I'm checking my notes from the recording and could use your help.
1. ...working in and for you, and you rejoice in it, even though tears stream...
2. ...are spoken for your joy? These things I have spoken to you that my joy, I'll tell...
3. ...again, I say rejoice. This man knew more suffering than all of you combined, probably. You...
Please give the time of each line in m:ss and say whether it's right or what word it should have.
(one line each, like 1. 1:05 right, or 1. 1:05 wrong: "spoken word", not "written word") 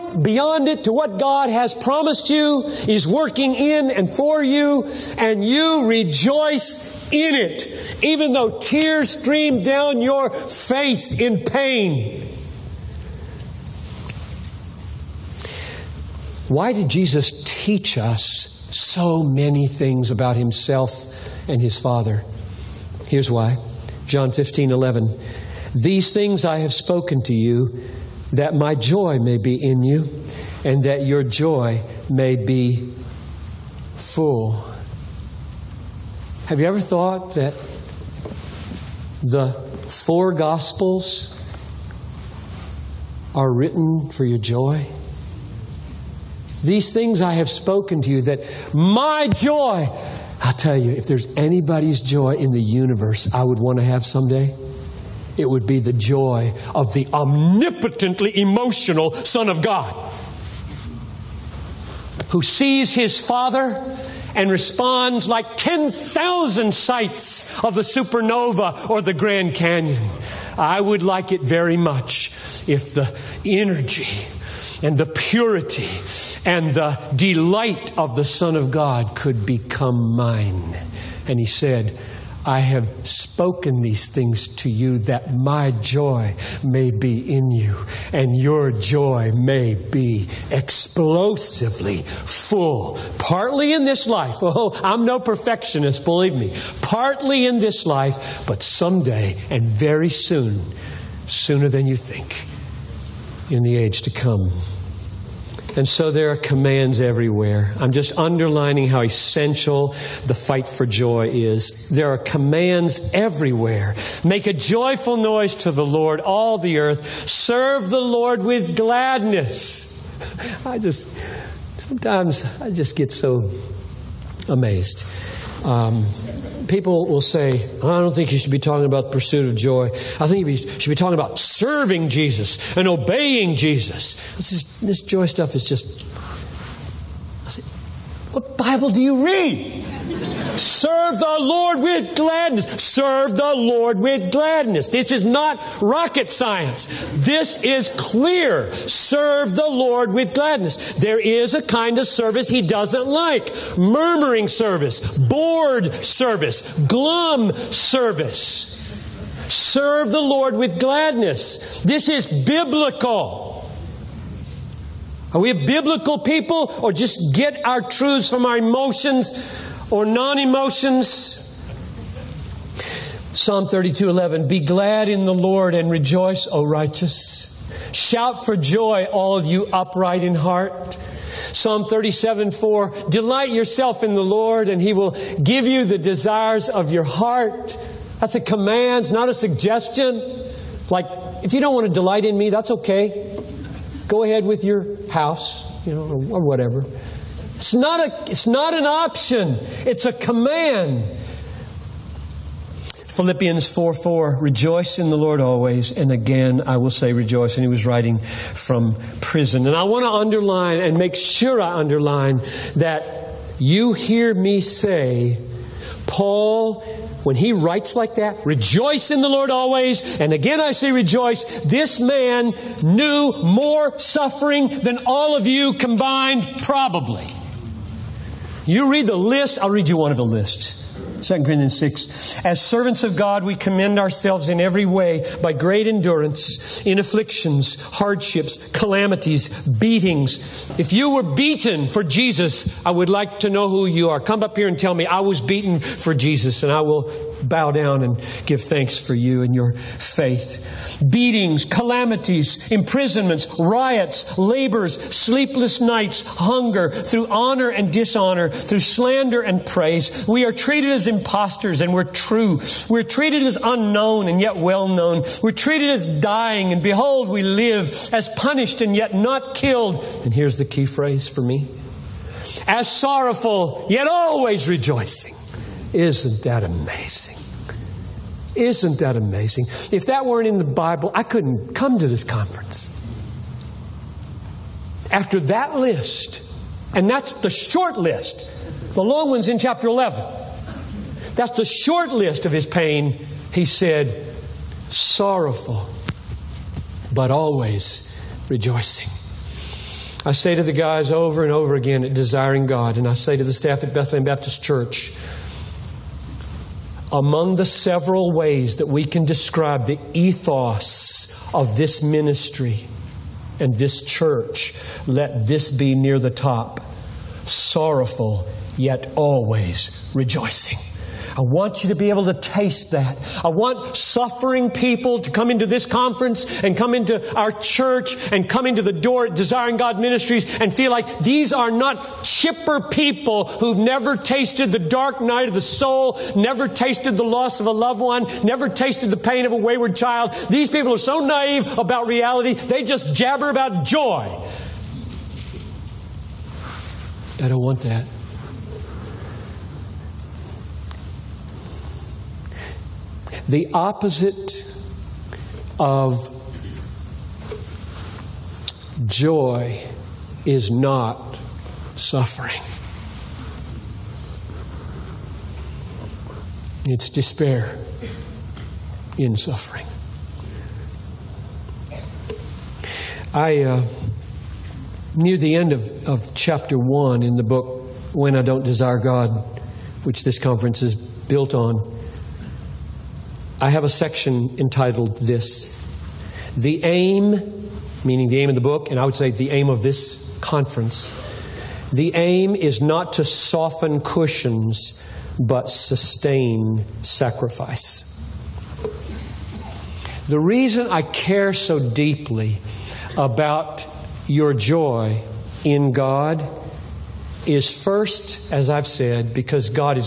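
1. 0:03 right
2. 0:43 wrong: "written", not "spoken"
3. 3:40 right.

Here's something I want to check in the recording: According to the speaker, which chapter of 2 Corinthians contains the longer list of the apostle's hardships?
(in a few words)
chapter 11.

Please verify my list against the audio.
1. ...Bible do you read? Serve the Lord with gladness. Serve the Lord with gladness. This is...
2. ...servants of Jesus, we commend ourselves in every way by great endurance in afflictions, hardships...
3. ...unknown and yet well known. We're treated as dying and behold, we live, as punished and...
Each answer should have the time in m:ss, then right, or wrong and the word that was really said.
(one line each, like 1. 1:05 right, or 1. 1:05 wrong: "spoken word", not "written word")
1. 2:18 right
2. 3:52 wrong: "God", not "Jesus"
3. 4:23 right.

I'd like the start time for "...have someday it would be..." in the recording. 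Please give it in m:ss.
0:53.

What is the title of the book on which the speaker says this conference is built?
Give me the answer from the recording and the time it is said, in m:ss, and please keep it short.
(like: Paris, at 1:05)
When I Don't Desire God, at 6:18.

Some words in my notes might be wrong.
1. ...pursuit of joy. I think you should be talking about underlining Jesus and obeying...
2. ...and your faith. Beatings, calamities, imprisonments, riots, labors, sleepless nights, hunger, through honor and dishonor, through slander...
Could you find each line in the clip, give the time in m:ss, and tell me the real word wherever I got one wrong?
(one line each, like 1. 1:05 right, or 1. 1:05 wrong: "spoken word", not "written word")
1. 2:09 wrong: "serving", not "underlining"
2. 4:09 right.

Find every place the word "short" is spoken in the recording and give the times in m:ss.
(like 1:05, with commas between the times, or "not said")
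4:47, 4:51.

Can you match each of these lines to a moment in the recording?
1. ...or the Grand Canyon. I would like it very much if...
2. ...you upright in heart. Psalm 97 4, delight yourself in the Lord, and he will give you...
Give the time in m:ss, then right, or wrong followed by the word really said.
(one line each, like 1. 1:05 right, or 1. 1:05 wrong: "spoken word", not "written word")
1. 1:08 right
2. 2:59 wrong: "37", not "97".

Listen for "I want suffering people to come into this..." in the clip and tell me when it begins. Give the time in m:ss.
5:23.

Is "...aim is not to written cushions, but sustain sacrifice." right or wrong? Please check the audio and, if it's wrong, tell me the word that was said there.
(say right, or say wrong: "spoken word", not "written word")
wrong: "soften", not "written".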